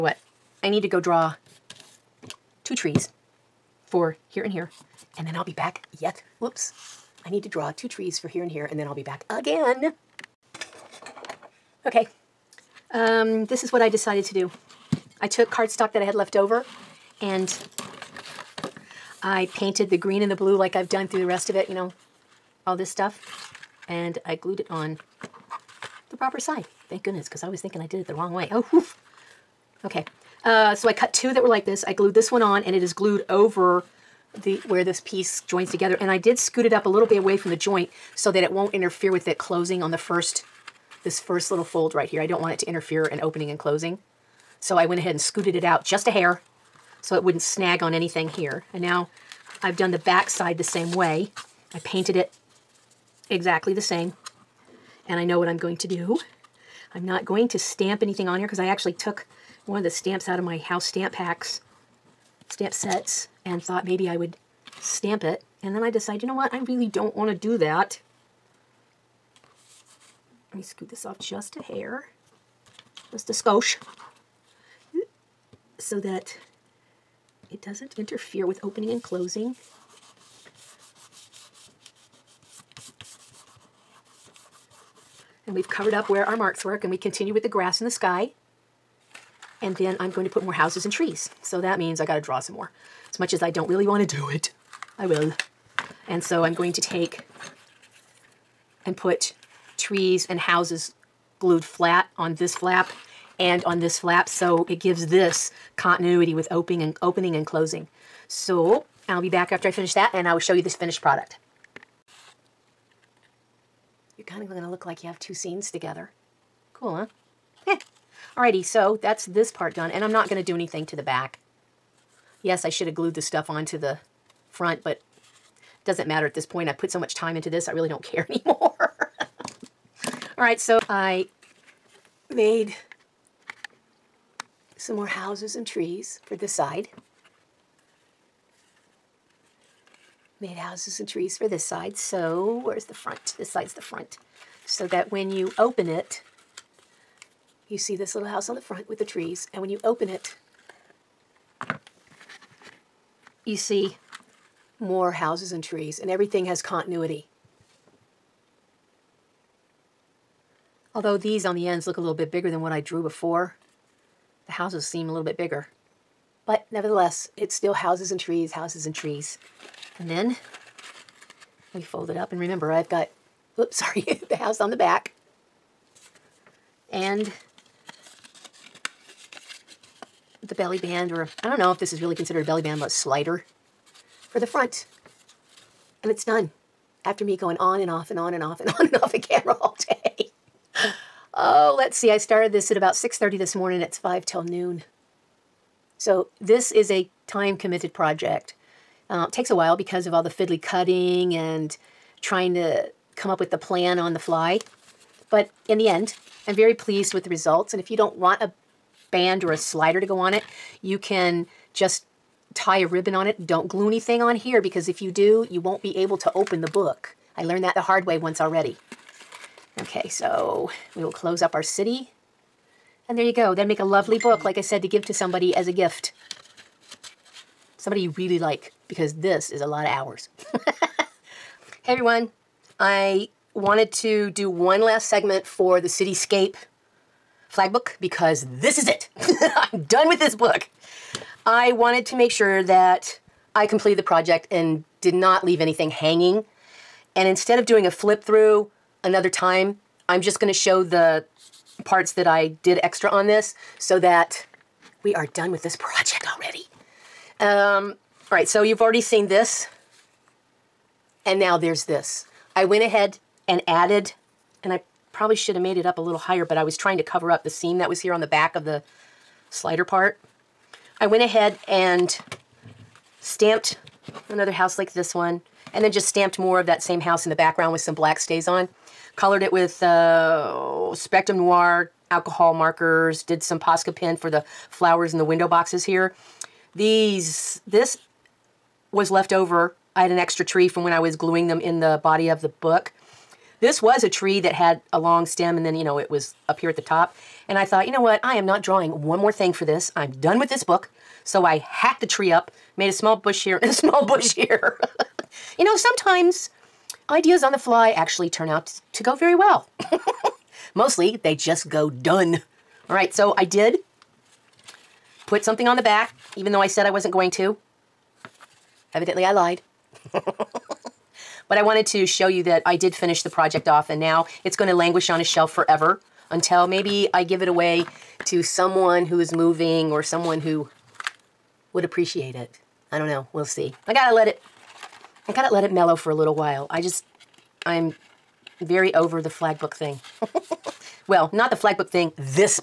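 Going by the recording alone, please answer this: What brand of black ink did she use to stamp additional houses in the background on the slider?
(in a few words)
StazOn.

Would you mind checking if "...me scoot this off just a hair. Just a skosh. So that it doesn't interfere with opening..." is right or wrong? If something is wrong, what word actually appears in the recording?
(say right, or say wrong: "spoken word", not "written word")
right.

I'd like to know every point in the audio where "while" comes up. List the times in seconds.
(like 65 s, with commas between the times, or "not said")
199 s, 336 s.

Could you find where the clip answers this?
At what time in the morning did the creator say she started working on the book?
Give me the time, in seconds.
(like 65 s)
192 s.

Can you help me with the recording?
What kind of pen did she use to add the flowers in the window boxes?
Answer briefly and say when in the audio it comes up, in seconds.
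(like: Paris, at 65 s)
Posca pen, at 283 s.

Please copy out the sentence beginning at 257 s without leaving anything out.
Um, all right, so you've already seen this.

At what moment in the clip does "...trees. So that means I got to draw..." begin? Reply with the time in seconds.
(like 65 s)
90 s.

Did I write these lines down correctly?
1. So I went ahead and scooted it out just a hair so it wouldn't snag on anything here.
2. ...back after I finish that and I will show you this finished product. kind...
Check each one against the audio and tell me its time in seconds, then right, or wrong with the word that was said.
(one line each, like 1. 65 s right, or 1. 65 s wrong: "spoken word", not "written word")
1. 44 s right
2. 109 s right.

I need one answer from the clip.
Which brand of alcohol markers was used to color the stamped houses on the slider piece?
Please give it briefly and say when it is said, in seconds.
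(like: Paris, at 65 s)
Spectrum Noir, at 280 s.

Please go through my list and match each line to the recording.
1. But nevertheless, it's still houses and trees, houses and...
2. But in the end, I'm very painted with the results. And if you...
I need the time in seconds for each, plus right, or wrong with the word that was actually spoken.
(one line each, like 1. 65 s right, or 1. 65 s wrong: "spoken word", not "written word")
1. 166 s right
2. 205 s wrong: "pleased", not "painted".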